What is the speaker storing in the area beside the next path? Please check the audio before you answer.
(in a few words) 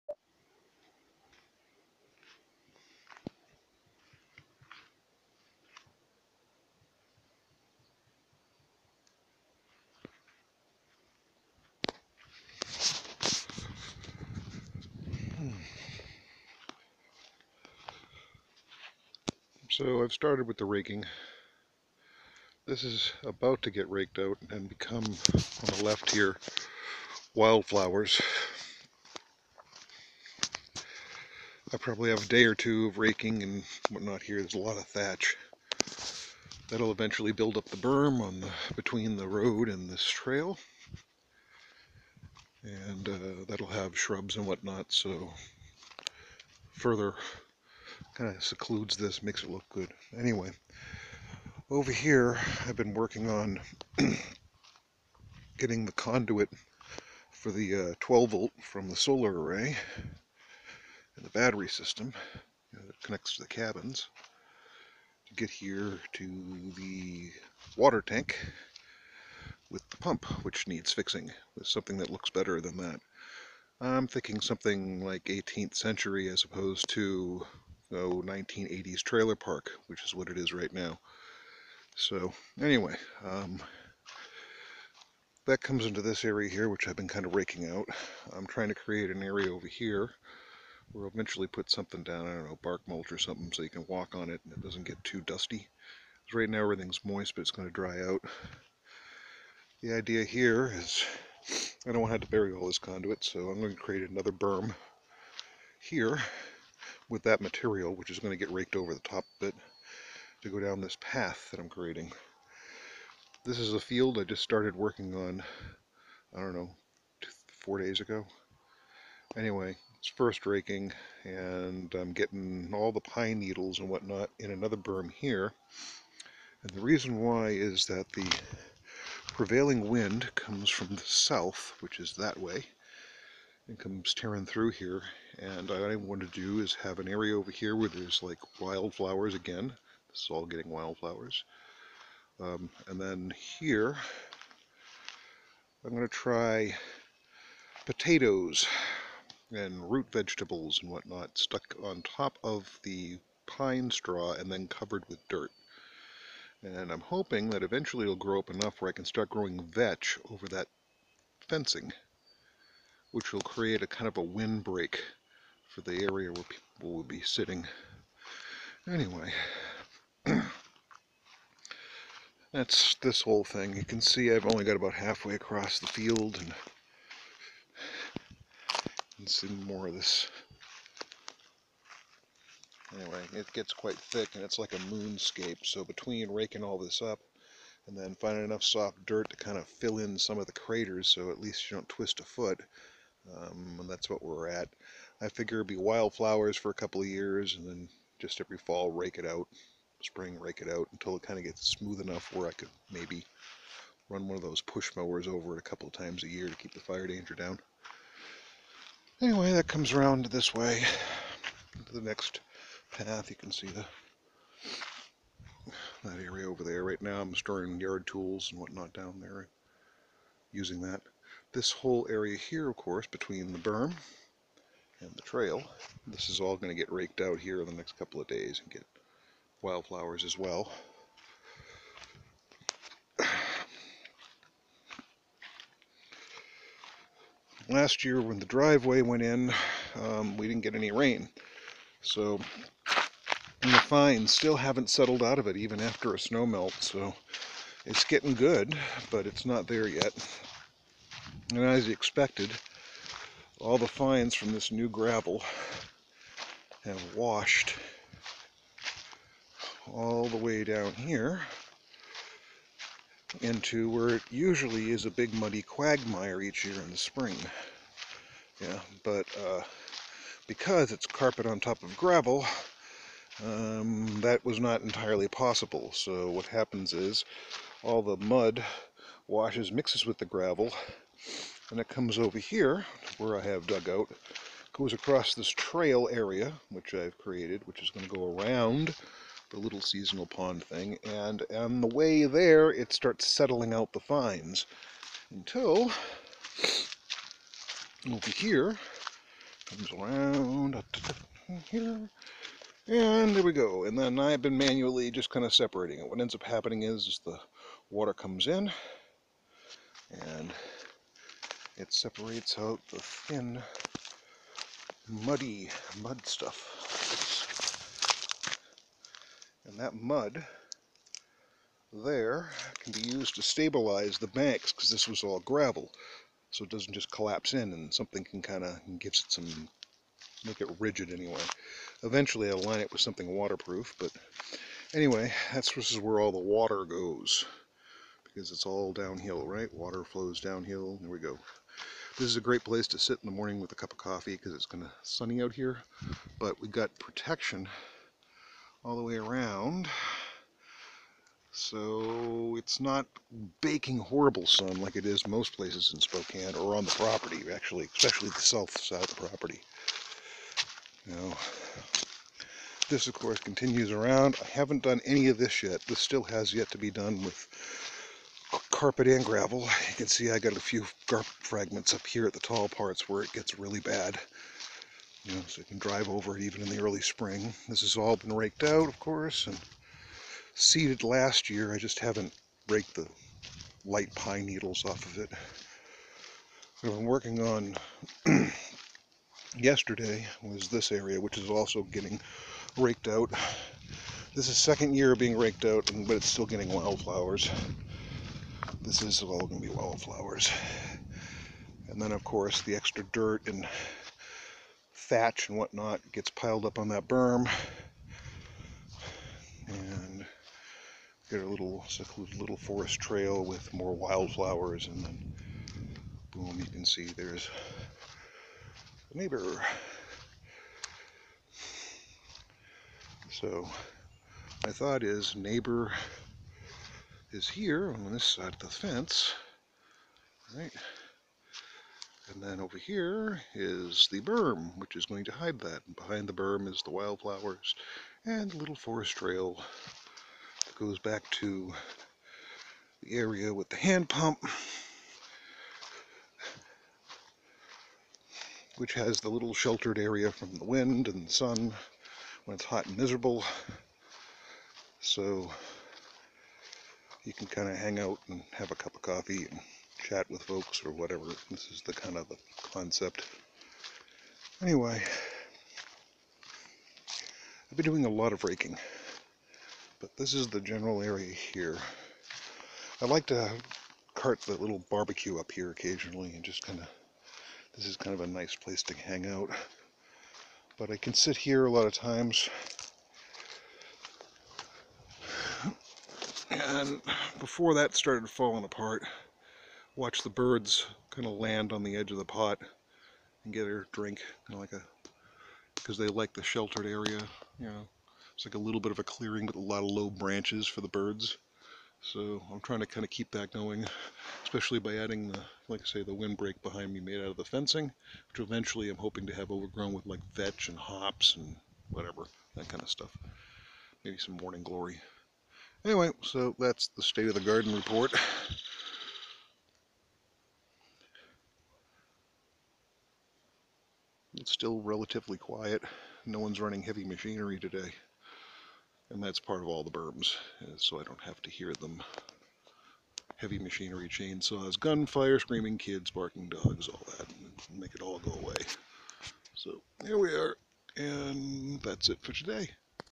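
yard tools.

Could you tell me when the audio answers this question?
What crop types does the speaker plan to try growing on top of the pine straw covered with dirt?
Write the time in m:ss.
2:27.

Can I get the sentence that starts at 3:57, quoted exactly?
Last year when the driveway went in, um, we didn't get any rain.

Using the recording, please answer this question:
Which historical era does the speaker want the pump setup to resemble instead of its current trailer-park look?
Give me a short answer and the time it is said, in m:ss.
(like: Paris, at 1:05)
18th century, at 1:15.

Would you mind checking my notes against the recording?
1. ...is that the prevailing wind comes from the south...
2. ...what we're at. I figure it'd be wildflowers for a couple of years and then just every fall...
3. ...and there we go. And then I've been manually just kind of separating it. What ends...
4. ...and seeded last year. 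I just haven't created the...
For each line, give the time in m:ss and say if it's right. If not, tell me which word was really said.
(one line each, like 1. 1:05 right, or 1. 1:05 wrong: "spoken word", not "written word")
1. 2:07 right
2. 3:14 right
3. 5:02 right
4. 6:19 wrong: "raked", not "created".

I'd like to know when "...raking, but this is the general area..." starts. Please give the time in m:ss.
7:48.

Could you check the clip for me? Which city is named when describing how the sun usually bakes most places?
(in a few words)
Spokane.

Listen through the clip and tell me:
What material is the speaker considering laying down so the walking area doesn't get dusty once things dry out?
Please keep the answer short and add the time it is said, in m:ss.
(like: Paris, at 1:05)
bark mulch, at 1:32.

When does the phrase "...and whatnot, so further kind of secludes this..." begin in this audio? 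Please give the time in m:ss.
0:44.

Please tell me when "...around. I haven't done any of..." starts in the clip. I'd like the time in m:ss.
6:03.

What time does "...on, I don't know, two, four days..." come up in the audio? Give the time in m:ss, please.
1:55.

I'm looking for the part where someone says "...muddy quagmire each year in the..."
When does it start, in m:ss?
4:25.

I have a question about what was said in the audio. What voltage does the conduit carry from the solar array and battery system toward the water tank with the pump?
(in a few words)
12 volt.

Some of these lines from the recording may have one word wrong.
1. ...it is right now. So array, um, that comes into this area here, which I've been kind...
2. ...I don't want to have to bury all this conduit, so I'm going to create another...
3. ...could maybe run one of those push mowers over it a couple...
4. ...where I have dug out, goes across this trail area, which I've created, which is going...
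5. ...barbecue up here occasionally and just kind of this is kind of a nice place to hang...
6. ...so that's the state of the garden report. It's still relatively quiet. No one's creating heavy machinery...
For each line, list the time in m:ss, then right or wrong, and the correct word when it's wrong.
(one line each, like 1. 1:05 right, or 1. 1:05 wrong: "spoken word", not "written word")
1. 1:20 wrong: "anyway", not "array"
2. 1:41 right
3. 3:22 right
4. 4:43 right
5. 7:54 right
6. 8:36 wrong: "running", not "creating".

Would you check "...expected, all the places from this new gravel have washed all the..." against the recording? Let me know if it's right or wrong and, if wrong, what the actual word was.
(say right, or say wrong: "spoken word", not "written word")
wrong: "fines", not "places".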